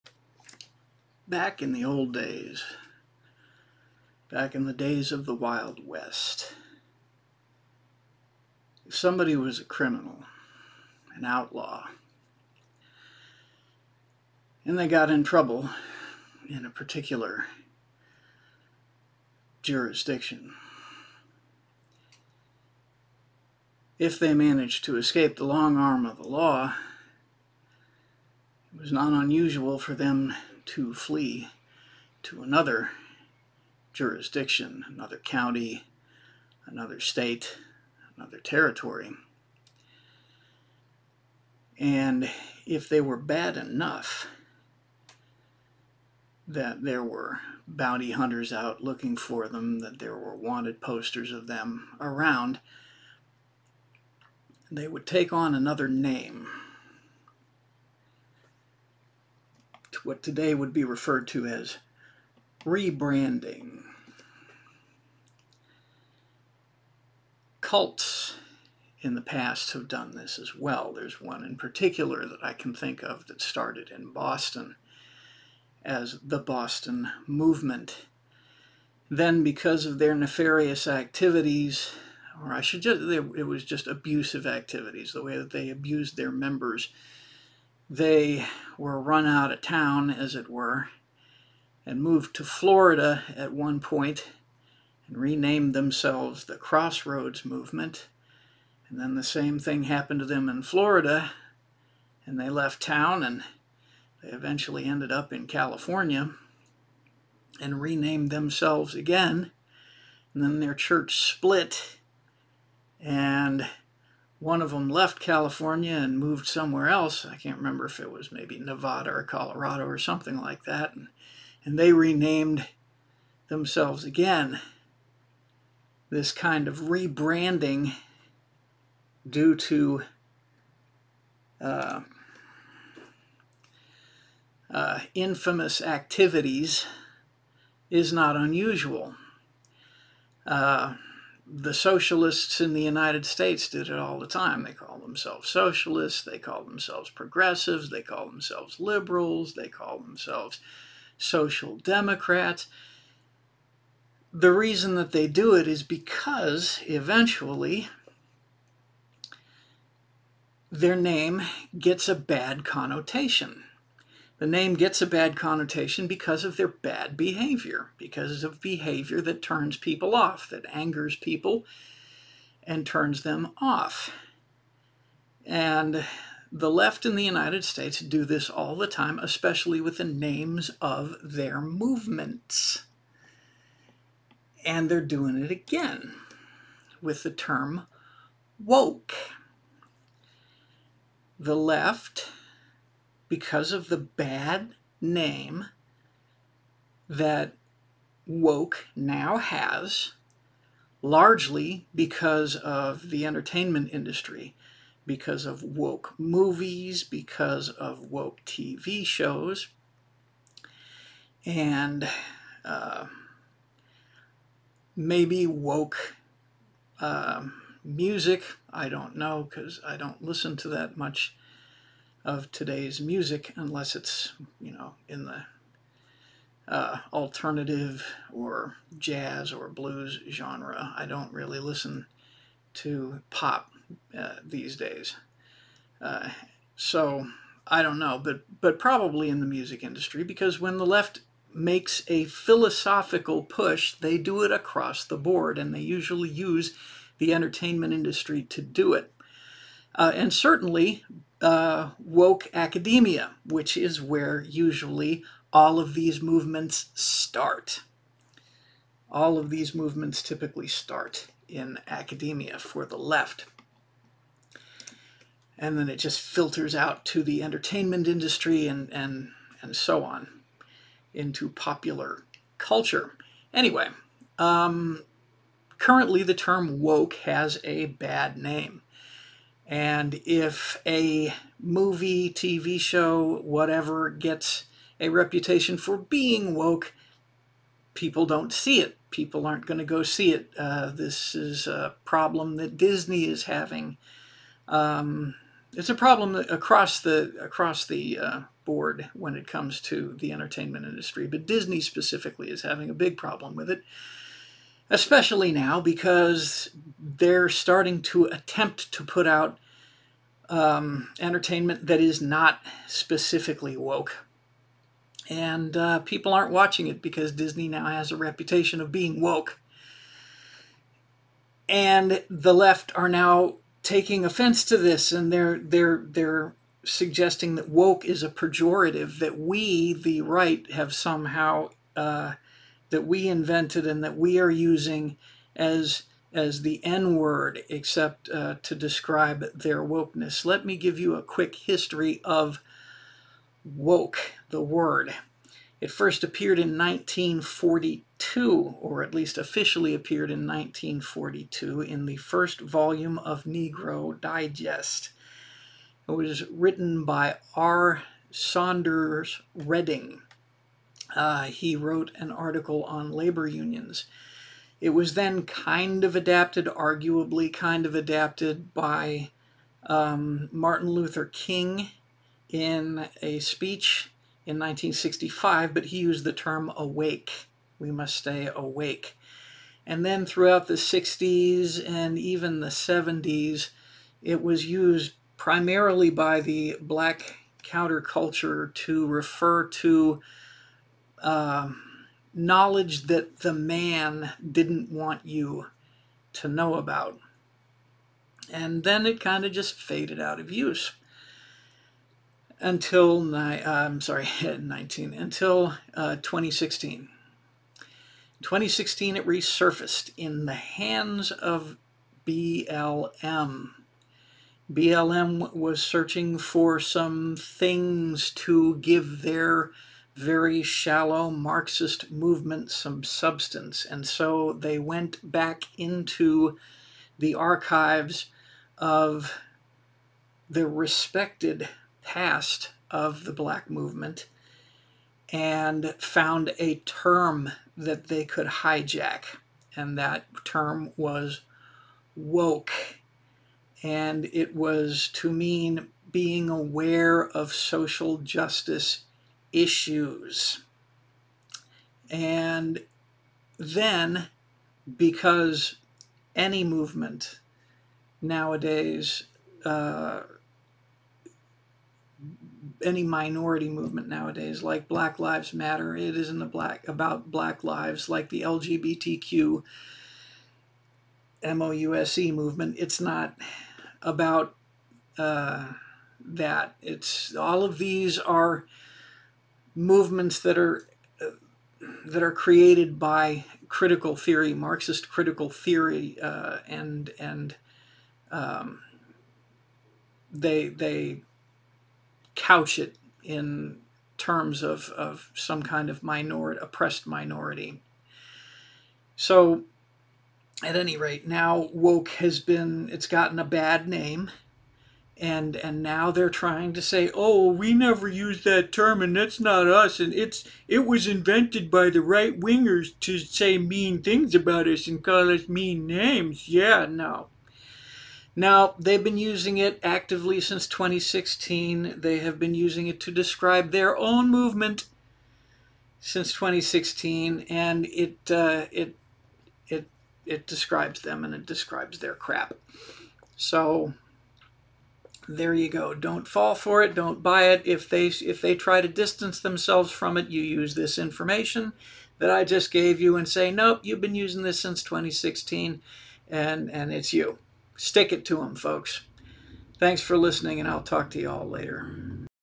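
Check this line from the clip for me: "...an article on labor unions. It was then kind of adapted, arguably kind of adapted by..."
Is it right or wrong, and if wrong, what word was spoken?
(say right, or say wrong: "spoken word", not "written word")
right.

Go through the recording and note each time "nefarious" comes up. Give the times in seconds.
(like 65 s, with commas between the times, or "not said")
80 s.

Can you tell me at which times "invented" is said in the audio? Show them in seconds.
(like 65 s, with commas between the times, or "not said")
333 s, 511 s.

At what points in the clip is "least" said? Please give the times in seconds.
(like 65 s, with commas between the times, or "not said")
349 s.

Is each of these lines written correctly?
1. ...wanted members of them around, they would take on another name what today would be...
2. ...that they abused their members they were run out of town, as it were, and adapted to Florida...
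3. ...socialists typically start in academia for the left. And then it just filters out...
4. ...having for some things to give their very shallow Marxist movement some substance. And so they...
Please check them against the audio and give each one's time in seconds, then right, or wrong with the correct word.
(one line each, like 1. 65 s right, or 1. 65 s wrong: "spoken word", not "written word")
1. 50 s wrong: "posters", not "members"
2. 85 s wrong: "moved", not "adapted"
3. 259 s wrong: "movements", not "socialists"
4. 415 s wrong: "searching", not "having".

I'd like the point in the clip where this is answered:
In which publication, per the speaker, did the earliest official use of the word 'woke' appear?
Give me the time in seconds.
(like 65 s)
353 s.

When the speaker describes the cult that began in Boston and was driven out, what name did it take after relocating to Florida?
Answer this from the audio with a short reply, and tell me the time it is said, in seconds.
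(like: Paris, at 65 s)
Crossroads Movement, at 96 s.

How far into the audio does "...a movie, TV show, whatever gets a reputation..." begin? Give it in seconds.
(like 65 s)
280 s.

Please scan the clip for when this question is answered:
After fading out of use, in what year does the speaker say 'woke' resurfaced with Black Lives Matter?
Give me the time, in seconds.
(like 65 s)
406 s.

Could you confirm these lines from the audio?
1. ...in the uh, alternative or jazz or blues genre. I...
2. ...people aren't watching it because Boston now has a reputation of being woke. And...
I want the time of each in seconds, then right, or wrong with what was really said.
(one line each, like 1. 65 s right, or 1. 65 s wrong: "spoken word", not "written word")
1. 225 s right
2. 315 s wrong: "Disney", not "Boston".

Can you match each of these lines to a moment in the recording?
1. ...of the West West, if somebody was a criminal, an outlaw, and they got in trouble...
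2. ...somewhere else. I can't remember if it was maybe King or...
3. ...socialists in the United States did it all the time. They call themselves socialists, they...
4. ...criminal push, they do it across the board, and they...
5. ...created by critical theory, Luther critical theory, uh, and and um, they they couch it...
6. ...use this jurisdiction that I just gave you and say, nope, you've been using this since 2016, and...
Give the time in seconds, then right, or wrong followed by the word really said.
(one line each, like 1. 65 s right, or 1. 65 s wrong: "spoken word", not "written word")
1. 5 s wrong: "Wild", not "West"
2. 116 s wrong: "Nevada", not "King"
3. 141 s right
4. 242 s wrong: "philosophical", not "criminal"
5. 482 s wrong: "Marxist", not "Luther"
6. 540 s wrong: "information", not "jurisdiction".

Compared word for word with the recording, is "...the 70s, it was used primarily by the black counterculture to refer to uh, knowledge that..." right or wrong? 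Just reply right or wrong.
right.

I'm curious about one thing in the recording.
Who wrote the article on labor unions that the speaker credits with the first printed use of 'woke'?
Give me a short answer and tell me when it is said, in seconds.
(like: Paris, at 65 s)
R. Saunders Redding, at 357 s.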